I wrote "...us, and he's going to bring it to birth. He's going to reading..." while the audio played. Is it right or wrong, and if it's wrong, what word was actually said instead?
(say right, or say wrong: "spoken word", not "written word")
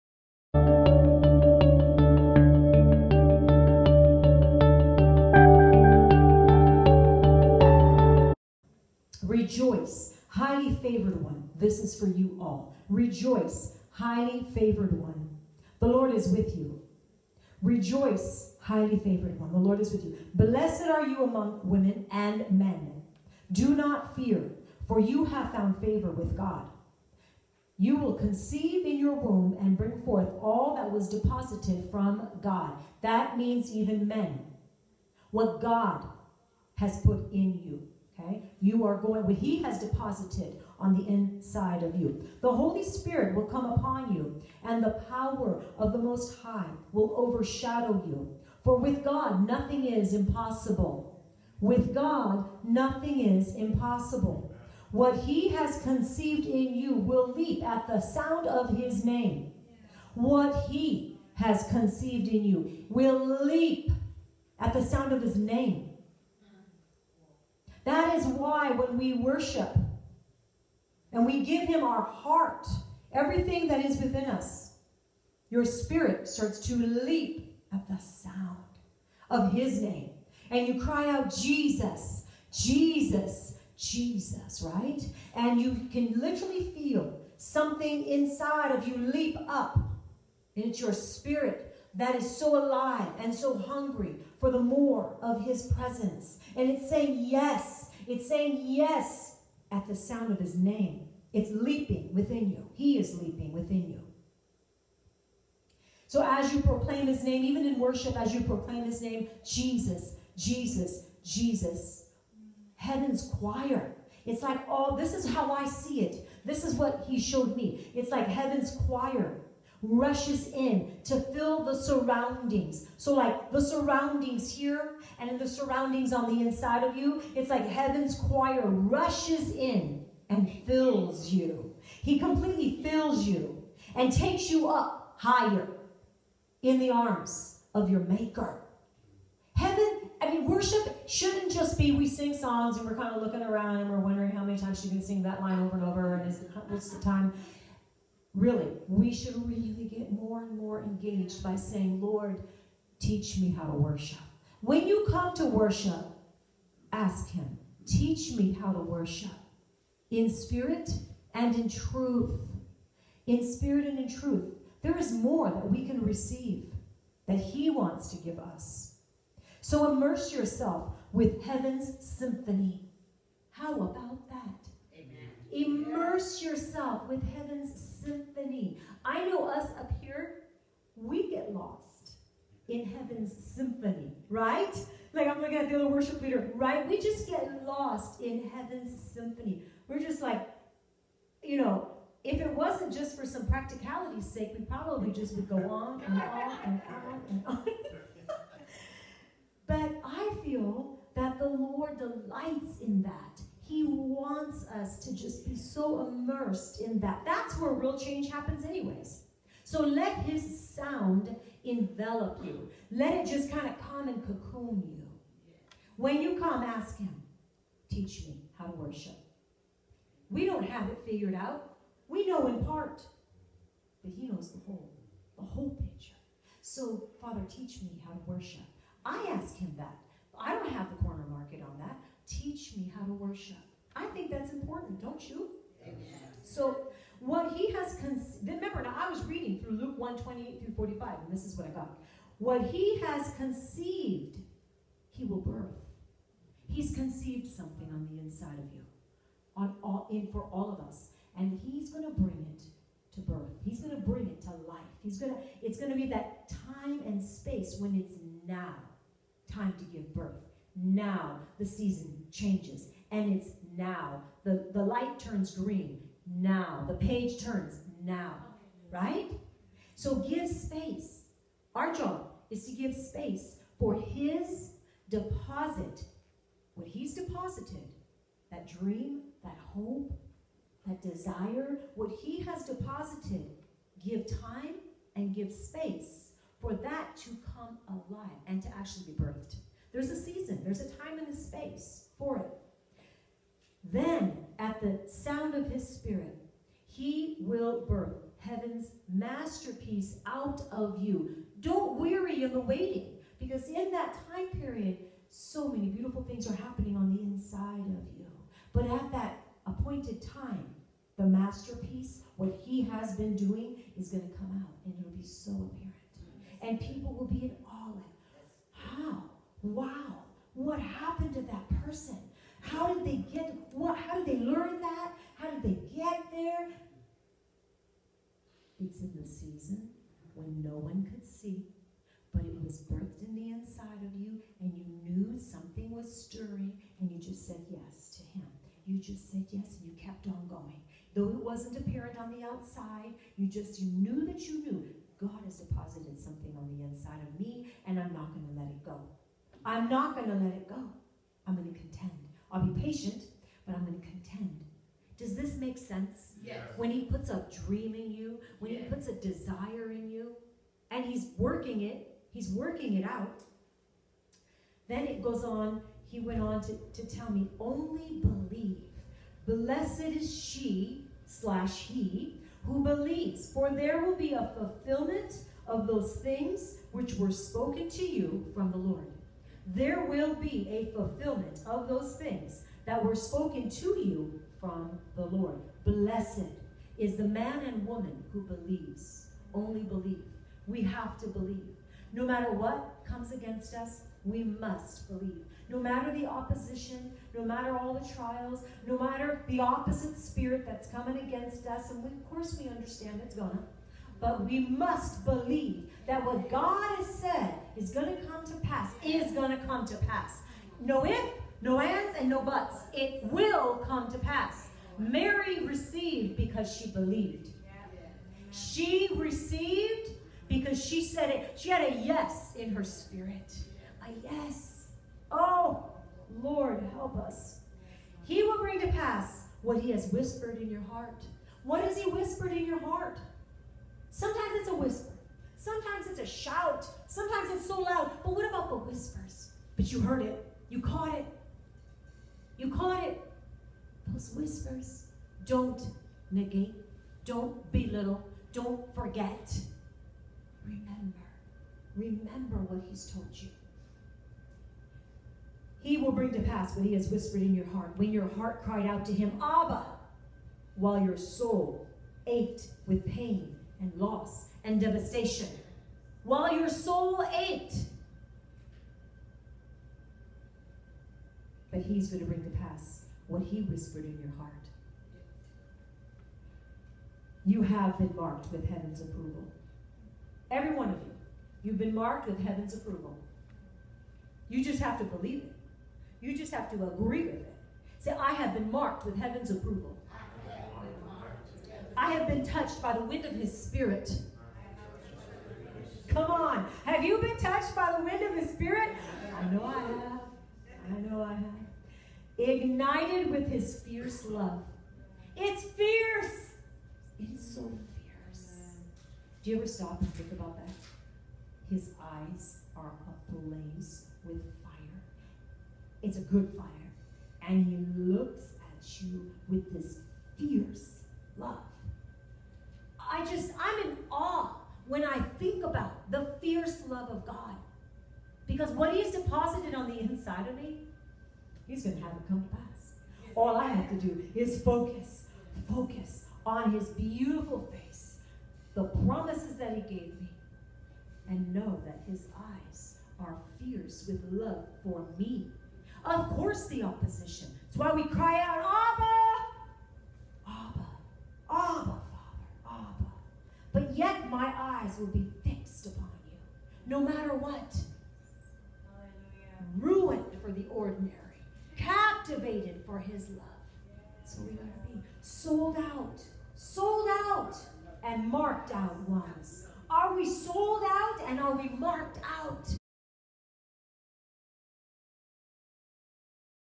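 wrong: "bring", not "reading".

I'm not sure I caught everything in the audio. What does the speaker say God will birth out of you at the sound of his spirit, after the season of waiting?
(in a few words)
heaven's masterpiece.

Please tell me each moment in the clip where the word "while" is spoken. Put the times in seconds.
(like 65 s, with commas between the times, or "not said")
460 s, 466 s.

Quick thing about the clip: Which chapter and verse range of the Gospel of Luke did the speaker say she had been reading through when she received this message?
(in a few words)
Luke 1, 28 through 45.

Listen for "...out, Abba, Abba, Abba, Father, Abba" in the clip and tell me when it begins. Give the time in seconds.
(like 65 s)
548 s.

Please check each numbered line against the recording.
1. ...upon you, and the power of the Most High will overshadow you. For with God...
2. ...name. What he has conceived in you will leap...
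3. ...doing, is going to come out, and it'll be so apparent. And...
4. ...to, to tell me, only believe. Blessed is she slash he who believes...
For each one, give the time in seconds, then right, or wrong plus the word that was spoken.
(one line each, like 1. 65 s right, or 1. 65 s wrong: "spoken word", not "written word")
1. 43 s right
2. 59 s right
3. 313 s right
4. 366 s right.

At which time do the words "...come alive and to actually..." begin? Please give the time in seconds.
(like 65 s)
287 s.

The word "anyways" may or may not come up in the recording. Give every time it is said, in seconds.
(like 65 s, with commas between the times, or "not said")
208 s.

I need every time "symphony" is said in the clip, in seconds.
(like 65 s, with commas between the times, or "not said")
171 s, 178 s, 183 s, 189 s.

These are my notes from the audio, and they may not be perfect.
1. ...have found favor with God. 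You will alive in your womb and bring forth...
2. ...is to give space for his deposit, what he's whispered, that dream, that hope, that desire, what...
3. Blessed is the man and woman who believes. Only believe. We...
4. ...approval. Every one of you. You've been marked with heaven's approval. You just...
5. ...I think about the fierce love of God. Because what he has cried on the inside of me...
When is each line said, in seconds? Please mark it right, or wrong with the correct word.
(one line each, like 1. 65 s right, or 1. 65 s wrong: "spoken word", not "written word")
1. 25 s wrong: "conceive", not "alive"
2. 272 s wrong: "deposited", not "whispered"
3. 385 s right
4. 479 s right
5. 525 s wrong: "deposited", not "cried".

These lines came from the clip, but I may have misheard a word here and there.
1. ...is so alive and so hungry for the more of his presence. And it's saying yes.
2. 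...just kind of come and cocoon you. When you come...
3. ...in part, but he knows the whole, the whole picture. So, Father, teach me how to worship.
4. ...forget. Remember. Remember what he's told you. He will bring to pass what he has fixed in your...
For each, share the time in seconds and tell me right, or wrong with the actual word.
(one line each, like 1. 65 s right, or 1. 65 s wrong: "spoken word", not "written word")
1. 92 s right
2. 213 s right
3. 222 s right
4. 448 s wrong: "whispered", not "fixed".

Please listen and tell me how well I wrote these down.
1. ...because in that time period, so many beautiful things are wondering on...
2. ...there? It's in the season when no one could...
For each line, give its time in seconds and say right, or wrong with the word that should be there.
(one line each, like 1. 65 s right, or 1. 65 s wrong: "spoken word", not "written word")
1. 303 s wrong: "happening", not "wondering"
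2. 326 s right.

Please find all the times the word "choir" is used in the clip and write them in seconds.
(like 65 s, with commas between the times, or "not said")
113 s, 118 s, 128 s.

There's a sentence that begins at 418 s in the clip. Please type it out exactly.
She received because she said it.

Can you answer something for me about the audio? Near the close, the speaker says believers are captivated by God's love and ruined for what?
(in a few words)
the ordinary.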